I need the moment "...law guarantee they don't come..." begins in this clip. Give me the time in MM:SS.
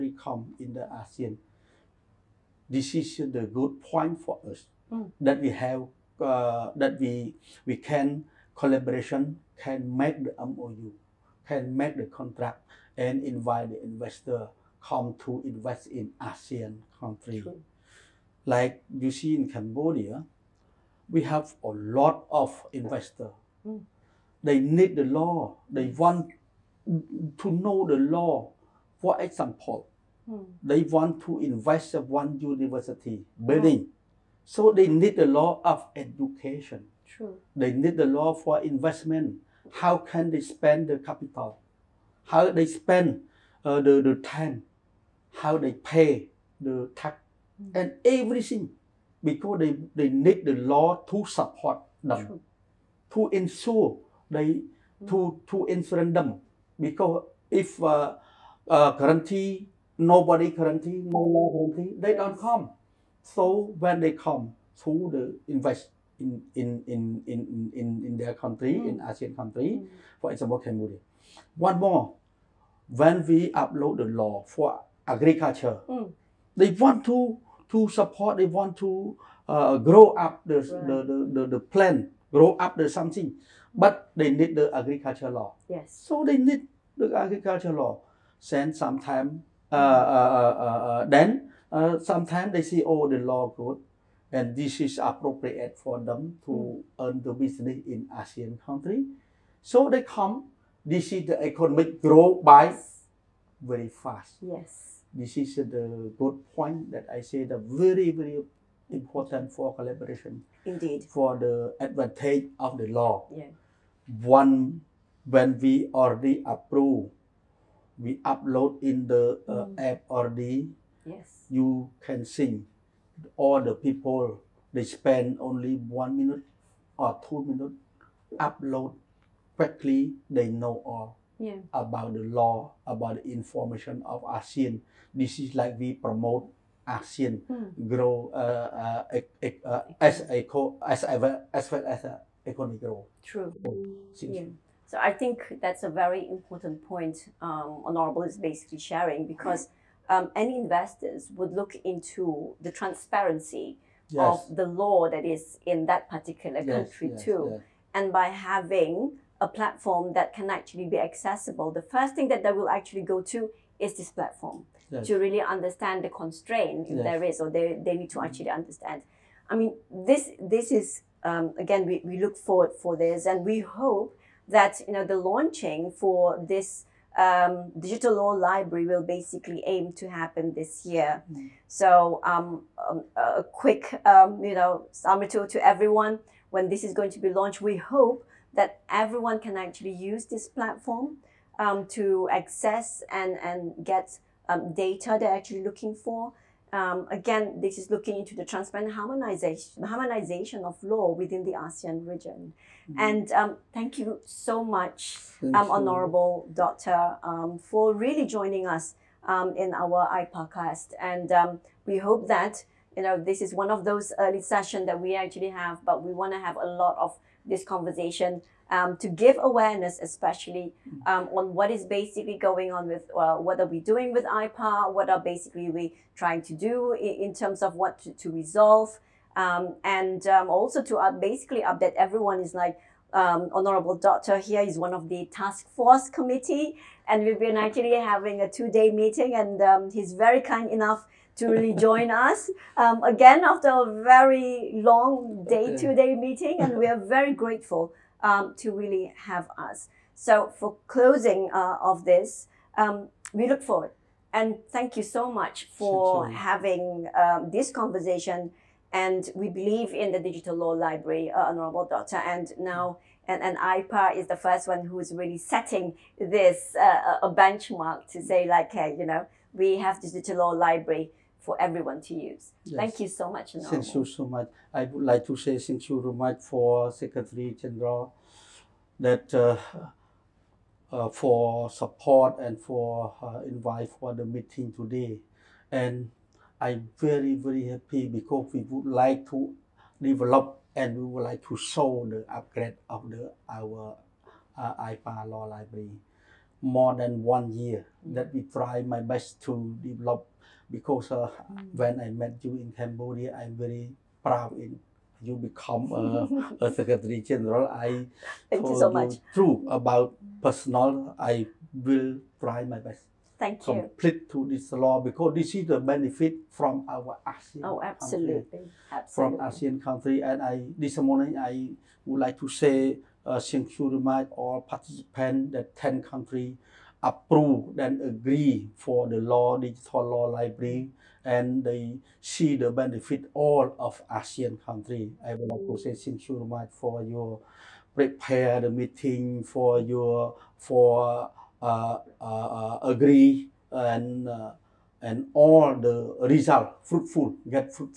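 01:01.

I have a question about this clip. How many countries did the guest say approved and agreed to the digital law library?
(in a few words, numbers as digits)
10.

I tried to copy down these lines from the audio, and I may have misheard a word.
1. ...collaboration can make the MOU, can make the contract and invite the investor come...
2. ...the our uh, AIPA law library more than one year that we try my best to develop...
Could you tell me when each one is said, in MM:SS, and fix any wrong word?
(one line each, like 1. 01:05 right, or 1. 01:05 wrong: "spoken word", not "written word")
1. 00:08 right
2. 04:53 right.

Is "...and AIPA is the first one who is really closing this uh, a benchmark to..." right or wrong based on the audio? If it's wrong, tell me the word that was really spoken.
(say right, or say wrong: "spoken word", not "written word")
wrong: "setting", not "closing".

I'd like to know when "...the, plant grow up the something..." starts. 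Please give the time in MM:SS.
01:21.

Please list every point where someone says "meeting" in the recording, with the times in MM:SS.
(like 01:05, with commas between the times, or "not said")
03:58, 04:06, 04:44, 05:38.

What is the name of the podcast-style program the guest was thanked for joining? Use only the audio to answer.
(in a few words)
AIPACAST.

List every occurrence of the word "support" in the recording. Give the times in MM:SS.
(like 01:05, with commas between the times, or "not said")
00:51, 01:17, 04:41.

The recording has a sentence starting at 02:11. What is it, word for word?
about the law, about the information of ASEAN.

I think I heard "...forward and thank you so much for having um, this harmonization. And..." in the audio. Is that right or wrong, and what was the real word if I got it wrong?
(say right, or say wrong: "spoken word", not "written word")
wrong: "conversation", not "harmonization".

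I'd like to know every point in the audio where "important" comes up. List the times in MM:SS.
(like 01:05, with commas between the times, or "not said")
01:48, 02:26.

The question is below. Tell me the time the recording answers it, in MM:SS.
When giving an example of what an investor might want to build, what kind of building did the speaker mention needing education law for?
00:32.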